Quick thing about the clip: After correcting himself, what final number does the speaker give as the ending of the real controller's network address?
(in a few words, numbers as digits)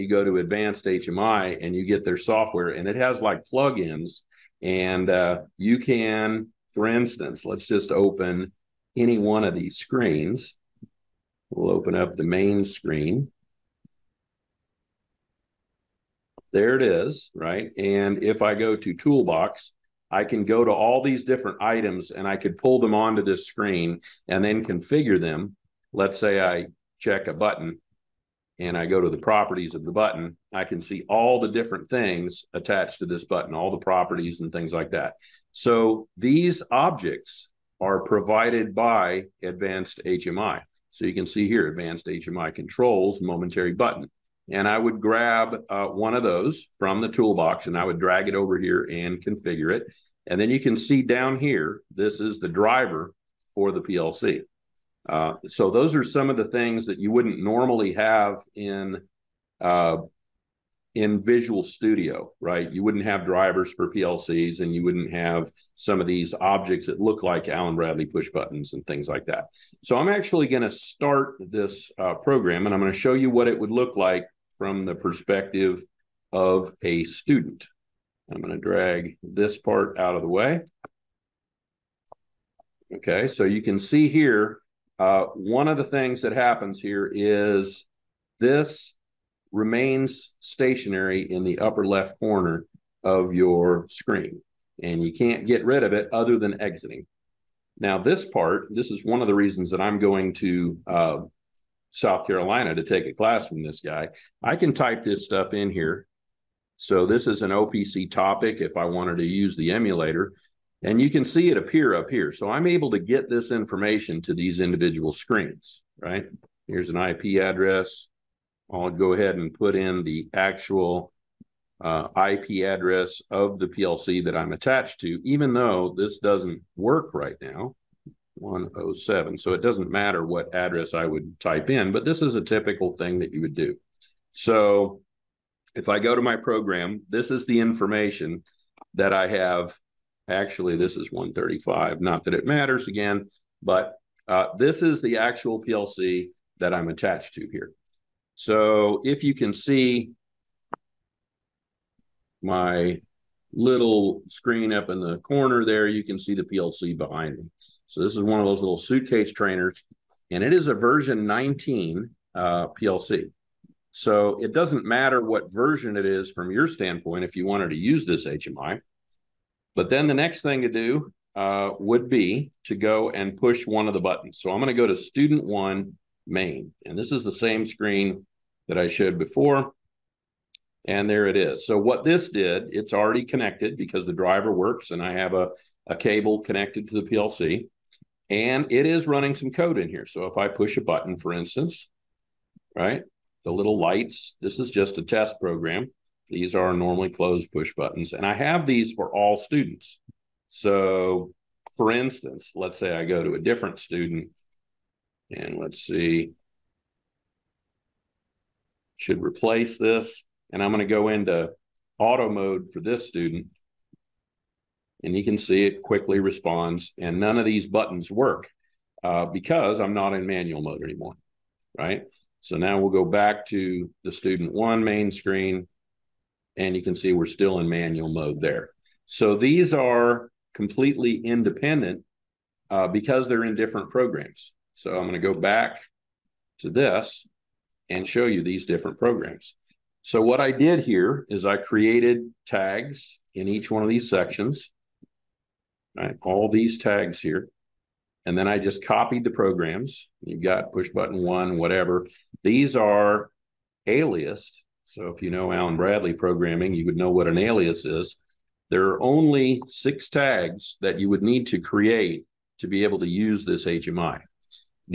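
135.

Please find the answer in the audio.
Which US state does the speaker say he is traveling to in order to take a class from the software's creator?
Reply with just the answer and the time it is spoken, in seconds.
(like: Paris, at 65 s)
South Carolina, at 101 s.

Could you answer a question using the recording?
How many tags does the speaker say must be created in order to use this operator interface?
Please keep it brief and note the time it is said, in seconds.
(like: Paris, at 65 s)
6, at 259 s.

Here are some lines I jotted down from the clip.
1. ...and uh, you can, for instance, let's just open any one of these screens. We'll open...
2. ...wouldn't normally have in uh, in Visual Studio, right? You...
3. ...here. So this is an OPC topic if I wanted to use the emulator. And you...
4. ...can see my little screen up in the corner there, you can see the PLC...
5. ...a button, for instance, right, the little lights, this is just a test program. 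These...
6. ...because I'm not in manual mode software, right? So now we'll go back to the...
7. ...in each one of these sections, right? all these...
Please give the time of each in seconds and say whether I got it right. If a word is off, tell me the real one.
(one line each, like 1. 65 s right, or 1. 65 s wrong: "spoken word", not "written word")
1. 4 s right
2. 57 s right
3. 105 s right
4. 149 s right
5. 190 s right
6. 219 s wrong: "anymore", not "software"
7. 243 s right.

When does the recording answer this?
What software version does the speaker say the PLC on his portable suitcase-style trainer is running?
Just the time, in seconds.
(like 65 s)
160 s.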